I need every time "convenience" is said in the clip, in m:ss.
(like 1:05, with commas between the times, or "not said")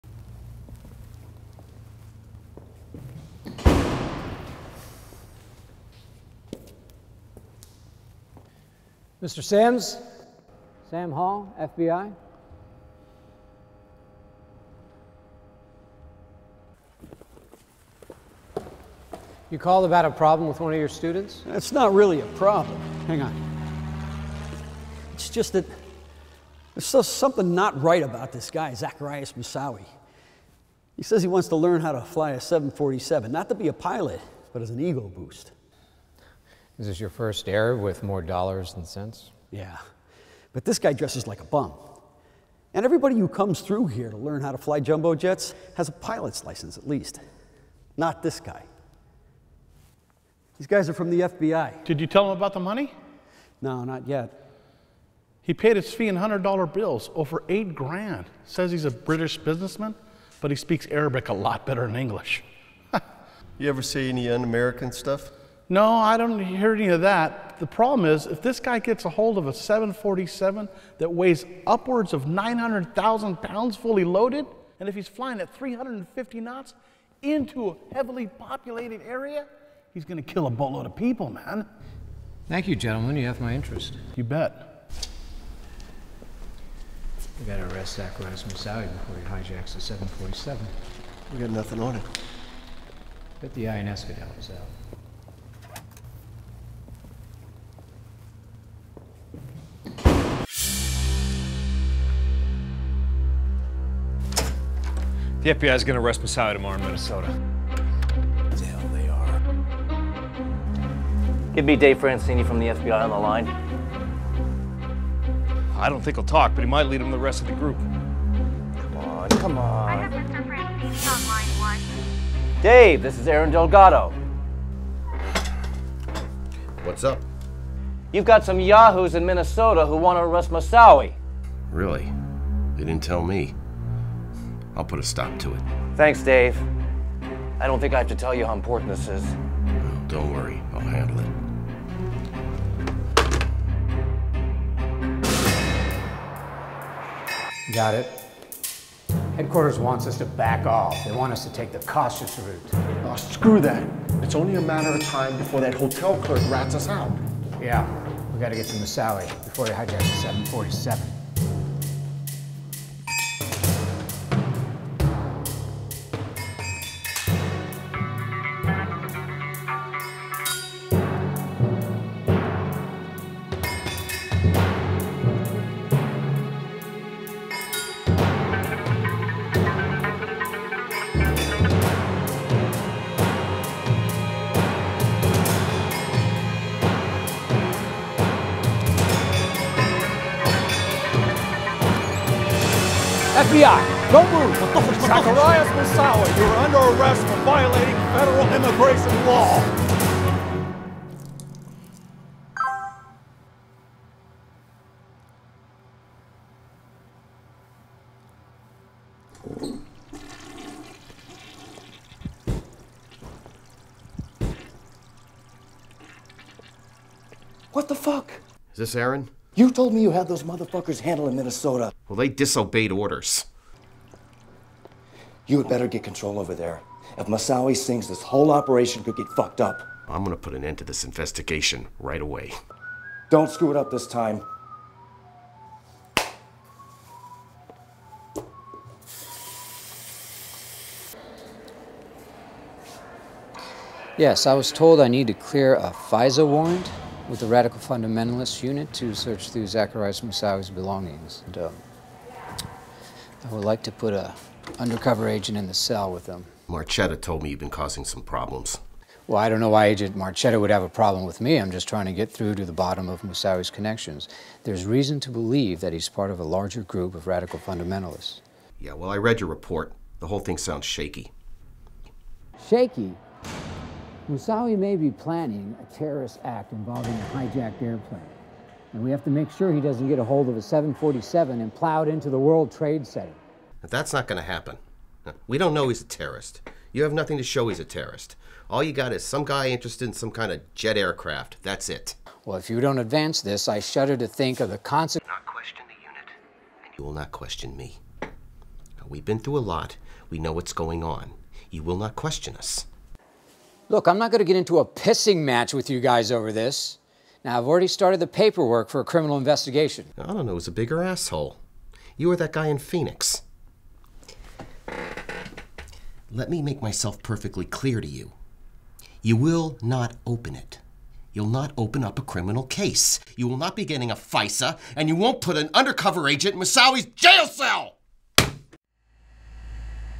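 not said.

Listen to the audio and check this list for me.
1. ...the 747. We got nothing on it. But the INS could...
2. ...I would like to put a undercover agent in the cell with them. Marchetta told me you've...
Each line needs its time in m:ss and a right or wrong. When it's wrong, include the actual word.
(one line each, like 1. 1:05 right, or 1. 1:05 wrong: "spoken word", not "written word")
1. 1:29 right
2. 4:13 right.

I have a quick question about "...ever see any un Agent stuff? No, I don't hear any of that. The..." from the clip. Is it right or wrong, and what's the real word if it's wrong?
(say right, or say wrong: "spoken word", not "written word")
wrong: "American", not "Agent".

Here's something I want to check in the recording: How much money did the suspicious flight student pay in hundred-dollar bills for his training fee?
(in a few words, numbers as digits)
over 8,000 dollars.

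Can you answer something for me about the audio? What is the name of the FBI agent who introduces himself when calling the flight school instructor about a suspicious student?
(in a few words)
Sam Hall.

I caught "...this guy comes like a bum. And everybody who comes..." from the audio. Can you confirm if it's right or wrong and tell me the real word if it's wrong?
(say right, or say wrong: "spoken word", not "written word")
wrong: "dresses", not "comes".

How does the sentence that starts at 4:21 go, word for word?
I'm just trying to get through to the bottom of Moussaoui's connections.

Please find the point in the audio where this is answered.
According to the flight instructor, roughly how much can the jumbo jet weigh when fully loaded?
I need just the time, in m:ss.
1:12.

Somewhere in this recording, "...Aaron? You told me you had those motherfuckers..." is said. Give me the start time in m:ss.
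3:38.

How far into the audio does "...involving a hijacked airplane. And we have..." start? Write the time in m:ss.
4:36.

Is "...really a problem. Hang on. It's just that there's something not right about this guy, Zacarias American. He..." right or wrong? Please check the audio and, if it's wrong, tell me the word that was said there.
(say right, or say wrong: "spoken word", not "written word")
wrong: "Moussaoui", not "American".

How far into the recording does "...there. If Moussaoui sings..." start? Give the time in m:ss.
3:46.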